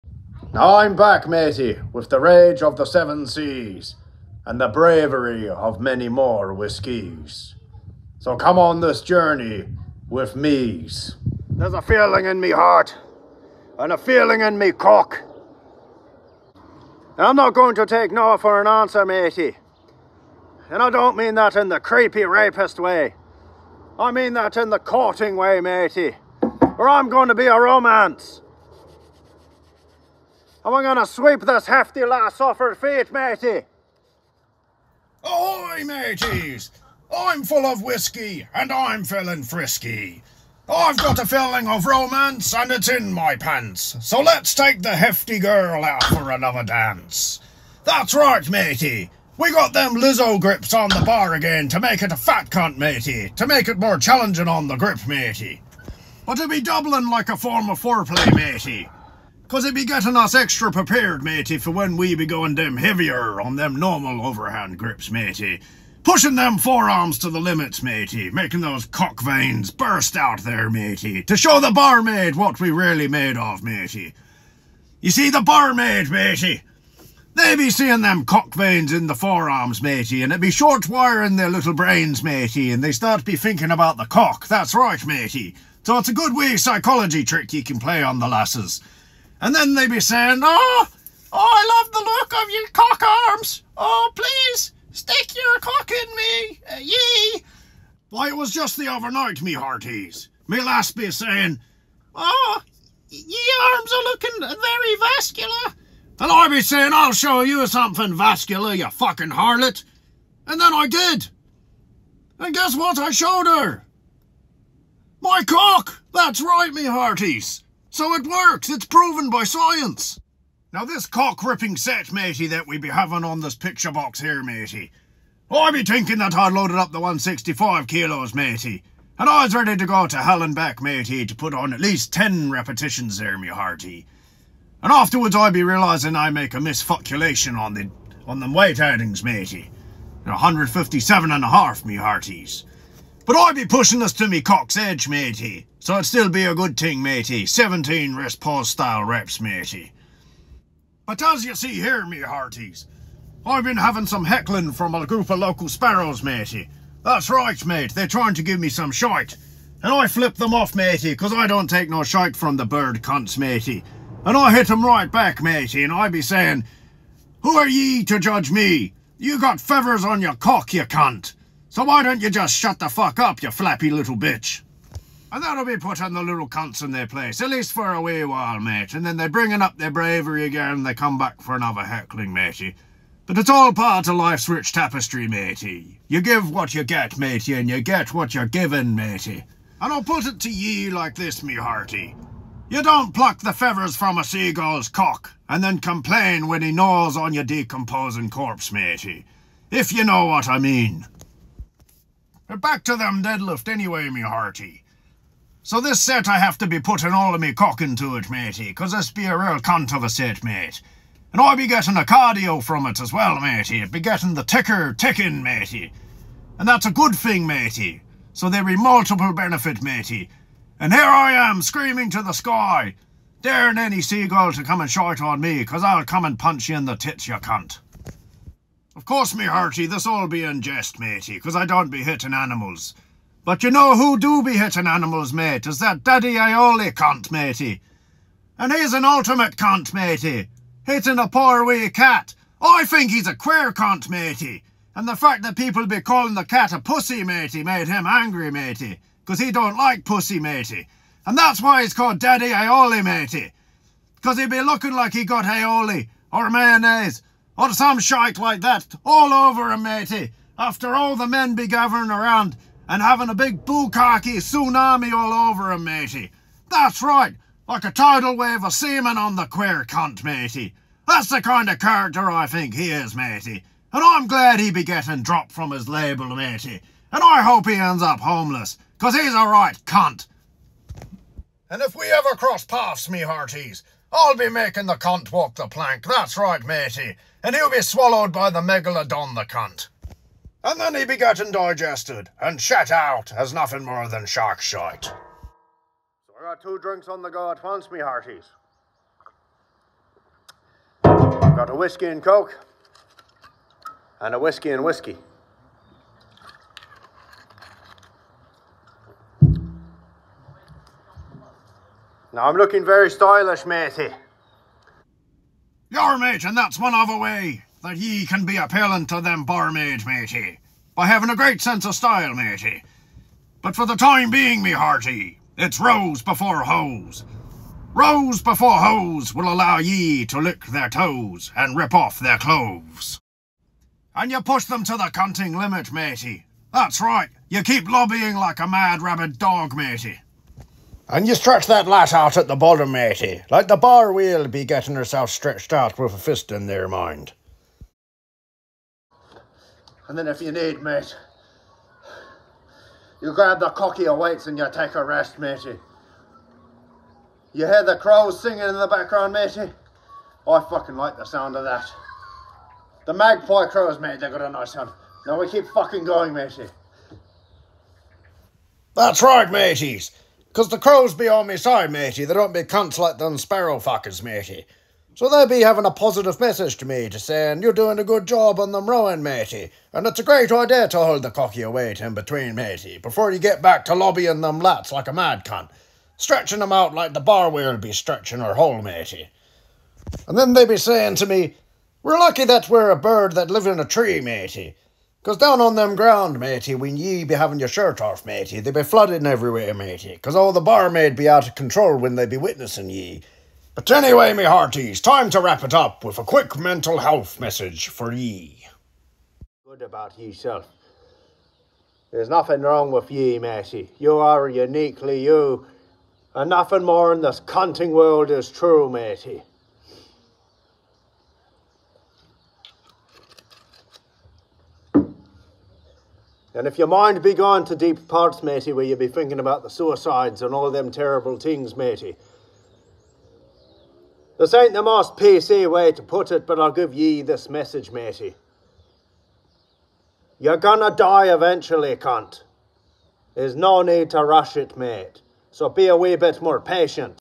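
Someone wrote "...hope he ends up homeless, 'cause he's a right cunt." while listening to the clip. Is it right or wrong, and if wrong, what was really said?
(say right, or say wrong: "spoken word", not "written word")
right.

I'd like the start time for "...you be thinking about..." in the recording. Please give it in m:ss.
7:08.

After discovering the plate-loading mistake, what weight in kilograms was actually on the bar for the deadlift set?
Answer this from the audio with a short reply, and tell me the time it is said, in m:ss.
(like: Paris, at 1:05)
157.5 kilos, at 2:20.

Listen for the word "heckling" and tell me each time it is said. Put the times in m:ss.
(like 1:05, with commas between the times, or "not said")
2:34, 3:01.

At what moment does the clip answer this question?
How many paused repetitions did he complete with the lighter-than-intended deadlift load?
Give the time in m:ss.
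2:27.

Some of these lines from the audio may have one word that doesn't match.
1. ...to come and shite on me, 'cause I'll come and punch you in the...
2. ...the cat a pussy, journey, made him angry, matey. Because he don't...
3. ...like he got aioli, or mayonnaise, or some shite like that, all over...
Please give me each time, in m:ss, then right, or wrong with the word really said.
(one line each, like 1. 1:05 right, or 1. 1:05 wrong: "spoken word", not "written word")
1. 3:44 right
2. 4:06 wrong: "matey", not "journey"
3. 4:14 right.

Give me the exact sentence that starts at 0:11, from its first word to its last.
There's a feeling in me heart and a feeling in me cock.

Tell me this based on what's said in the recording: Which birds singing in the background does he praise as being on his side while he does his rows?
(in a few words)
magpie crows.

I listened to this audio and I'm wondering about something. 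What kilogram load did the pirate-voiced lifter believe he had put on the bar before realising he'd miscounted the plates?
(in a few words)
165 kilos.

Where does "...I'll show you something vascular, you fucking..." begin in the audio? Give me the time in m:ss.
1:46.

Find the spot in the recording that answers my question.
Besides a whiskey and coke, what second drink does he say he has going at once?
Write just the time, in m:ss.
5:04.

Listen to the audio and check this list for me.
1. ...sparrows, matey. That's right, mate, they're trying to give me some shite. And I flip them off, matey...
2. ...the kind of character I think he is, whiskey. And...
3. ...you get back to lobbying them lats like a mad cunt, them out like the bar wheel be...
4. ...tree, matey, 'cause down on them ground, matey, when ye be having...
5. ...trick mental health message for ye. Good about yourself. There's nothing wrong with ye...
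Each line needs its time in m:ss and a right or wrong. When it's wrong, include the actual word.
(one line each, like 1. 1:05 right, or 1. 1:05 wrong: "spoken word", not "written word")
1. 2:35 right
2. 4:31 wrong: "matey", not "whiskey"
3. 6:23 right
4. 6:33 right
5. 6:46 wrong: "quick", not "trick".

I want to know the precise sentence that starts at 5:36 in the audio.
That's right, you keep lobbying like a mad rabid dog, matey.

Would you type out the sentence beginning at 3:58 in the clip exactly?
And he's an ultimate cunt, matey.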